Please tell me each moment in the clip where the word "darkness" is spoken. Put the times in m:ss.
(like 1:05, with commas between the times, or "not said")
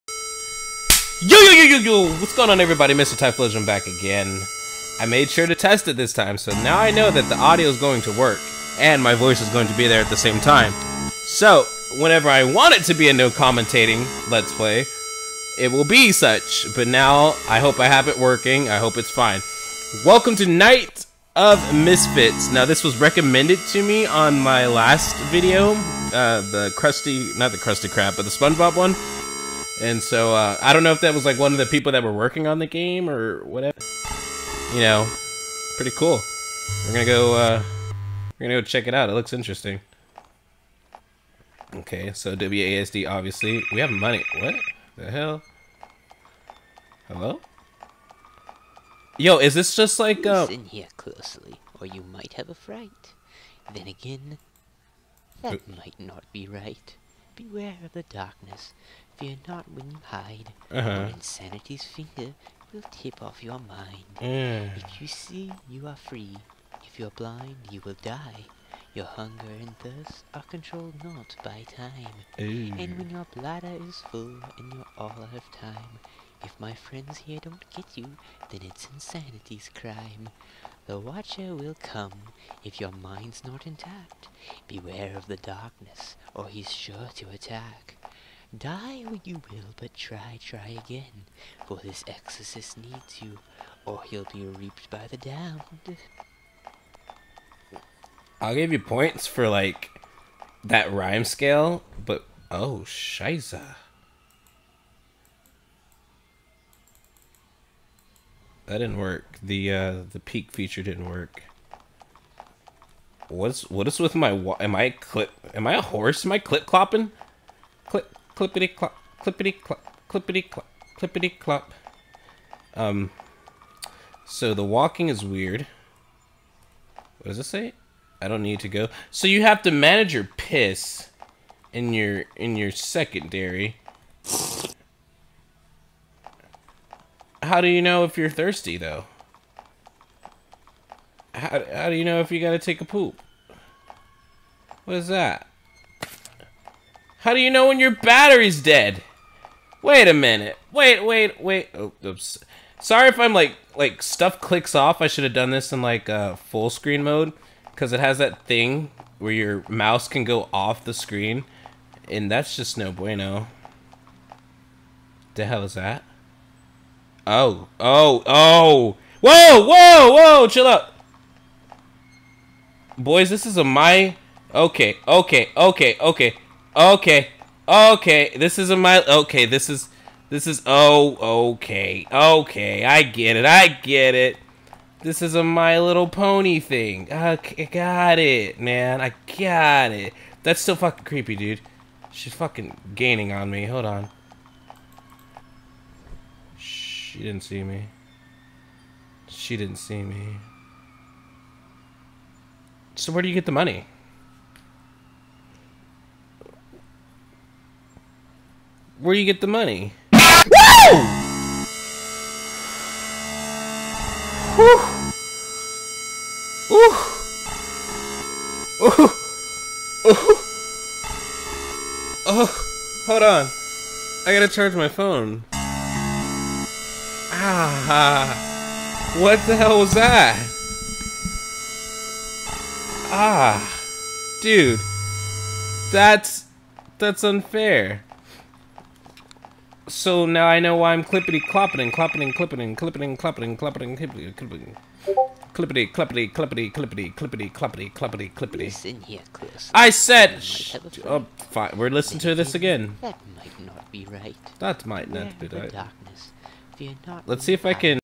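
0:58, 1:25.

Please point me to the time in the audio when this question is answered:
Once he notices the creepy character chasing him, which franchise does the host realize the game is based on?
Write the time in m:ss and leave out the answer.
3:05.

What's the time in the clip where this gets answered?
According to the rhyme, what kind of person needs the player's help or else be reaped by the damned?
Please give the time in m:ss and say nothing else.
1:32.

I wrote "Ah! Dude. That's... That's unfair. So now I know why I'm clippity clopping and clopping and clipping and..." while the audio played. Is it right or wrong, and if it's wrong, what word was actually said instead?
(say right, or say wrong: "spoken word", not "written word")
right.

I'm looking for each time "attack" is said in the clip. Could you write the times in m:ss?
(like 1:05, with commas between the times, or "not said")
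1:27.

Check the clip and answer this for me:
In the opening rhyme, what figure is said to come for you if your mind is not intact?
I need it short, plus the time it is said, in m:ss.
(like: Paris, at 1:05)
The Watcher, at 1:20.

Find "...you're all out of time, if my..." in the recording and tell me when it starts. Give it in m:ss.
1:14.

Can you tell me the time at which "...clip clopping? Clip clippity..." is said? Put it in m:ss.
1:56.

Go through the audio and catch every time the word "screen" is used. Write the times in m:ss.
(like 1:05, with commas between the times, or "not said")
2:36, 2:40.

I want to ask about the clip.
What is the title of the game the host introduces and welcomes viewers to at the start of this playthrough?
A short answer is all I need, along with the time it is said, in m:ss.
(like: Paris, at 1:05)
Night of Misfits, at 0:20.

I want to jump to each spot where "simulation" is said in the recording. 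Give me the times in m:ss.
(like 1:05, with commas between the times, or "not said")
not said.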